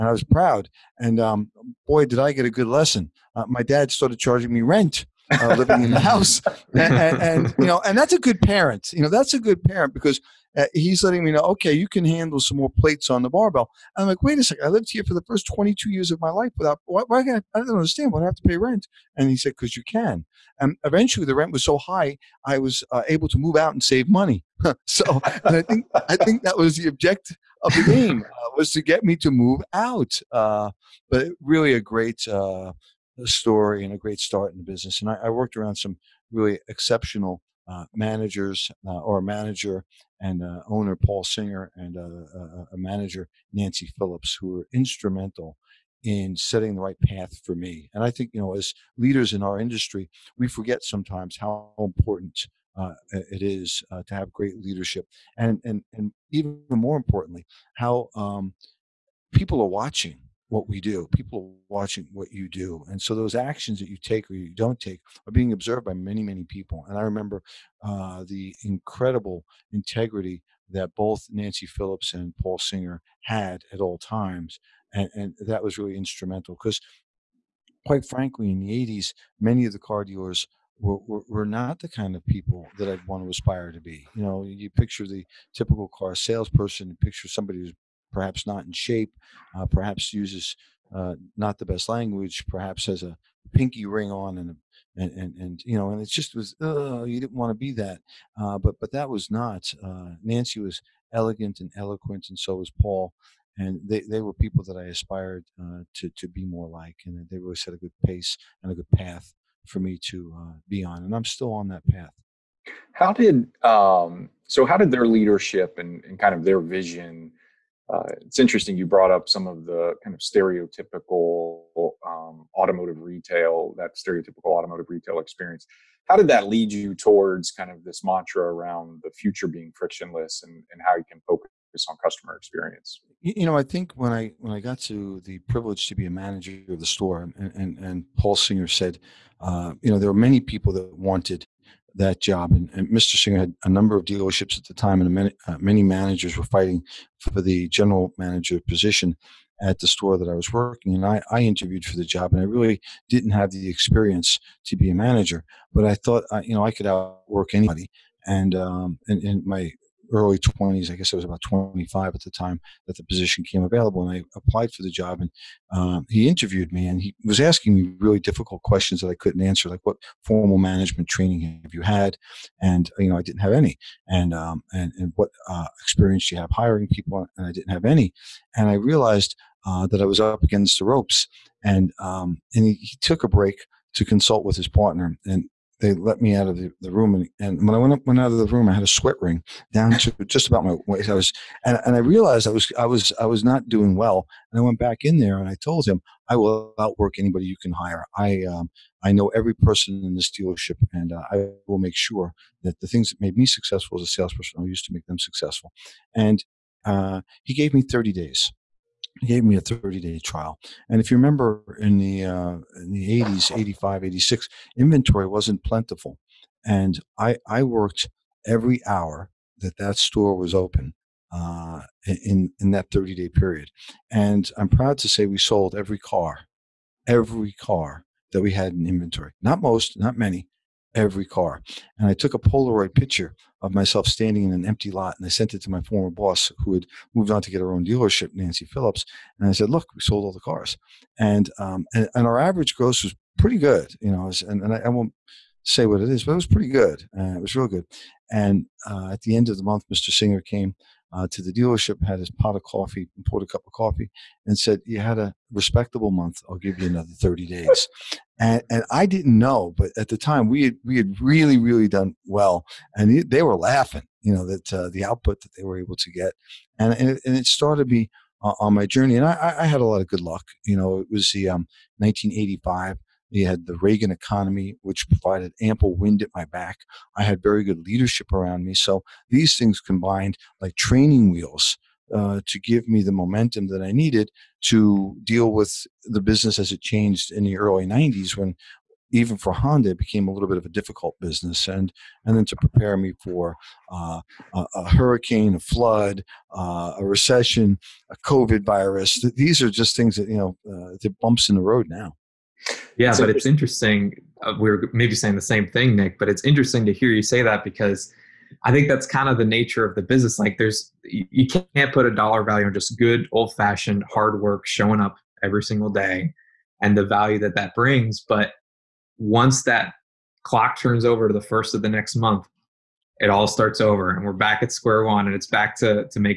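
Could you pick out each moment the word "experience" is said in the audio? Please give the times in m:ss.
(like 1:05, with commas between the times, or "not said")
2:05, 2:12, 2:33, 2:55.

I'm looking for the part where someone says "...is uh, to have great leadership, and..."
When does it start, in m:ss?
0:53.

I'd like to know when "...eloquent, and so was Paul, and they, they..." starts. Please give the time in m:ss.
1:41.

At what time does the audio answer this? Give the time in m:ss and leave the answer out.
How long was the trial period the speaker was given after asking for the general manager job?
3:29.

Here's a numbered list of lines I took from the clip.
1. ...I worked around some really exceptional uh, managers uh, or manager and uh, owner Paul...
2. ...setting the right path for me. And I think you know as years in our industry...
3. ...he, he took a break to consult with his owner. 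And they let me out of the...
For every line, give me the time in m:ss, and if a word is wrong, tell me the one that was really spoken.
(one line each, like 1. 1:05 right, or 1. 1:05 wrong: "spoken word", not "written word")
1. 0:35 right
2. 0:46 wrong: "leaders", not "years"
3. 3:02 wrong: "partner", not "owner".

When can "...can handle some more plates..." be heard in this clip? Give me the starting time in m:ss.
0:11.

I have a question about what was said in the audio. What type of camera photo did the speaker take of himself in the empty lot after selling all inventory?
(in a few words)
Polaroid.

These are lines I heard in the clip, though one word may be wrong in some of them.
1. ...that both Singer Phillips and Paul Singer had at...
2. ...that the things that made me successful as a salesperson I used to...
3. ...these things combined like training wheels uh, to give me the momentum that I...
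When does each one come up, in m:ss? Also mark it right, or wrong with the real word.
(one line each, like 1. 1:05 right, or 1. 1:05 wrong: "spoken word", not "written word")
1. 1:10 wrong: "Nancy", not "Singer"
2. 3:22 right
3. 4:39 right.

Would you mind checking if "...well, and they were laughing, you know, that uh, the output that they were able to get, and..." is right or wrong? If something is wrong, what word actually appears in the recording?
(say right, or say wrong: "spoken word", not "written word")
right.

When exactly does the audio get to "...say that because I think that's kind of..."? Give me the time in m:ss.
5:07.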